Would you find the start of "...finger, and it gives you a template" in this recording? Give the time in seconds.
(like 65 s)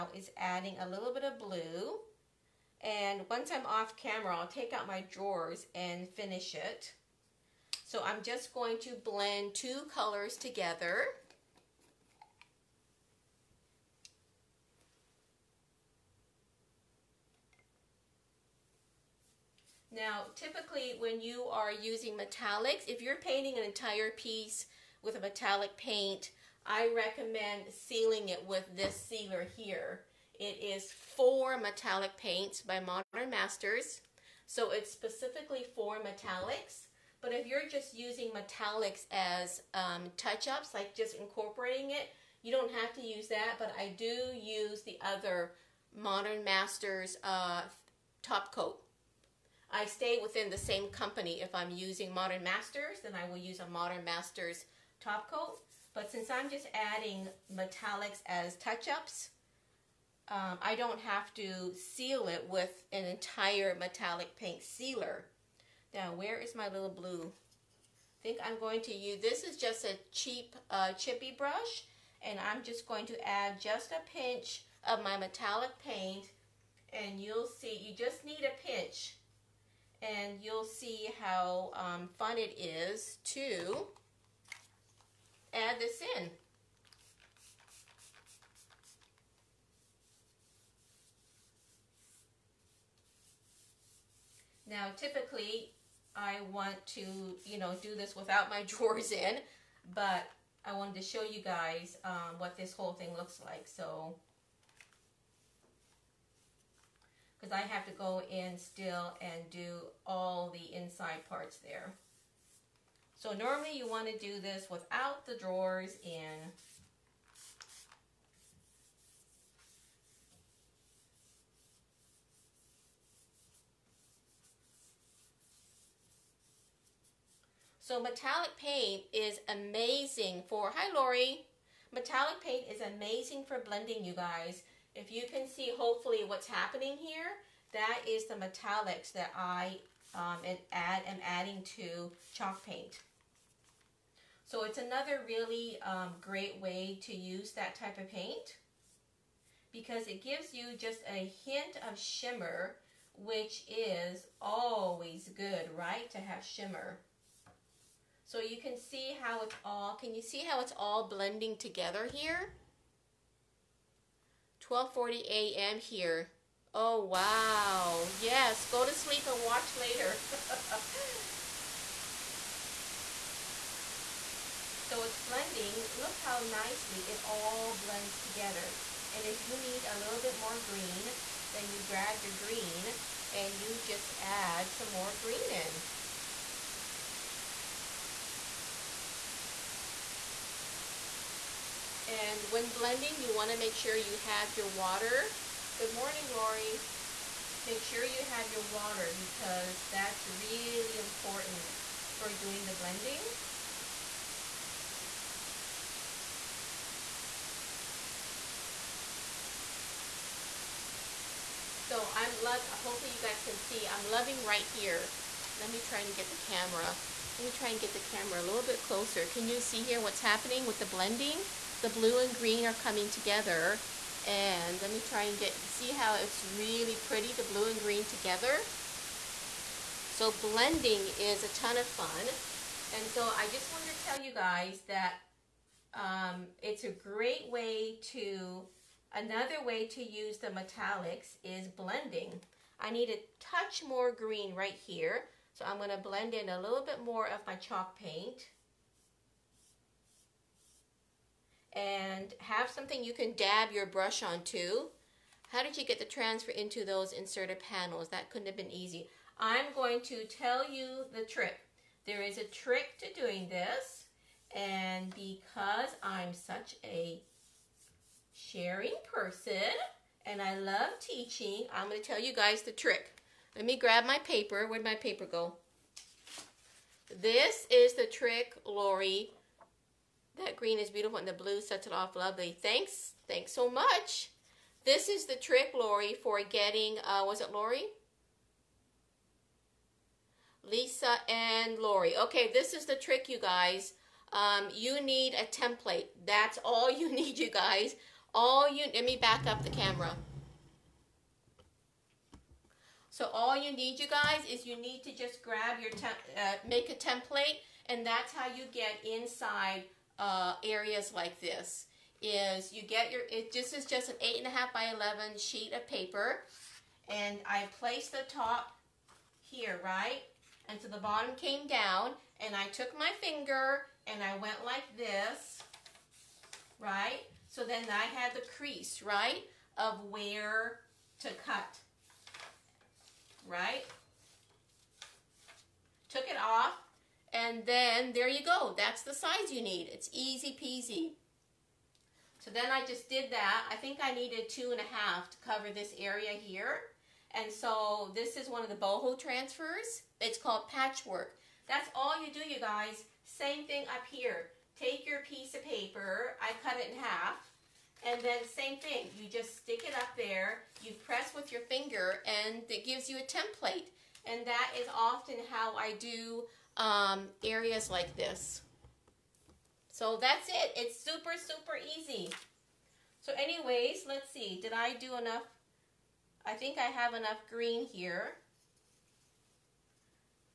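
361 s.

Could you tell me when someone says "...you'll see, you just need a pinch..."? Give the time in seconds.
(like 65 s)
77 s.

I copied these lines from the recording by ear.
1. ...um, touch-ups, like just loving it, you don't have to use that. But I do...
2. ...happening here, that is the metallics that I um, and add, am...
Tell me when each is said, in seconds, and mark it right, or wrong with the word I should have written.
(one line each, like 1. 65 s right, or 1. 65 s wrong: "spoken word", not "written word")
1. 39 s wrong: "incorporating", not "loving"
2. 136 s right.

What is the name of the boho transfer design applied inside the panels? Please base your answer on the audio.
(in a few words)
patchwork.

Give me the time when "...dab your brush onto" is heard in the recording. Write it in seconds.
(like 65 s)
253 s.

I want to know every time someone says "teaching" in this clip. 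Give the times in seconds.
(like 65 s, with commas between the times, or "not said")
270 s.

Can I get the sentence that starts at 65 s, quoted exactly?
Now, where is my little blue?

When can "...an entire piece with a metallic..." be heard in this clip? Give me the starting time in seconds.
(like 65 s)
23 s.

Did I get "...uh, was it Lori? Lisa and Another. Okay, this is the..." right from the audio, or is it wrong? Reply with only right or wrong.
wrong.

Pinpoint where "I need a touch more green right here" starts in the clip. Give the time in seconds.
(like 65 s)
242 s.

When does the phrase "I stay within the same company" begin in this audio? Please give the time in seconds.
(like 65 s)
49 s.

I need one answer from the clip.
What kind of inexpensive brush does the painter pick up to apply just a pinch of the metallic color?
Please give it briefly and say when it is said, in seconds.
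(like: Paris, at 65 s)
chippy brush, at 70 s.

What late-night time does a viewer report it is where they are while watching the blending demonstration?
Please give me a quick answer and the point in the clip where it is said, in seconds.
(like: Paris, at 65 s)
12:40 a.m., at 164 s.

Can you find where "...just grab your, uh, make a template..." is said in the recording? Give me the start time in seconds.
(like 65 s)
305 s.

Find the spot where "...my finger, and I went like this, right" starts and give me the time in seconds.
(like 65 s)
322 s.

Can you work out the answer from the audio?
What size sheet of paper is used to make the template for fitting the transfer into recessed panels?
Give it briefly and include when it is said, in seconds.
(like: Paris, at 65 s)
8.5 by 11, at 314 s.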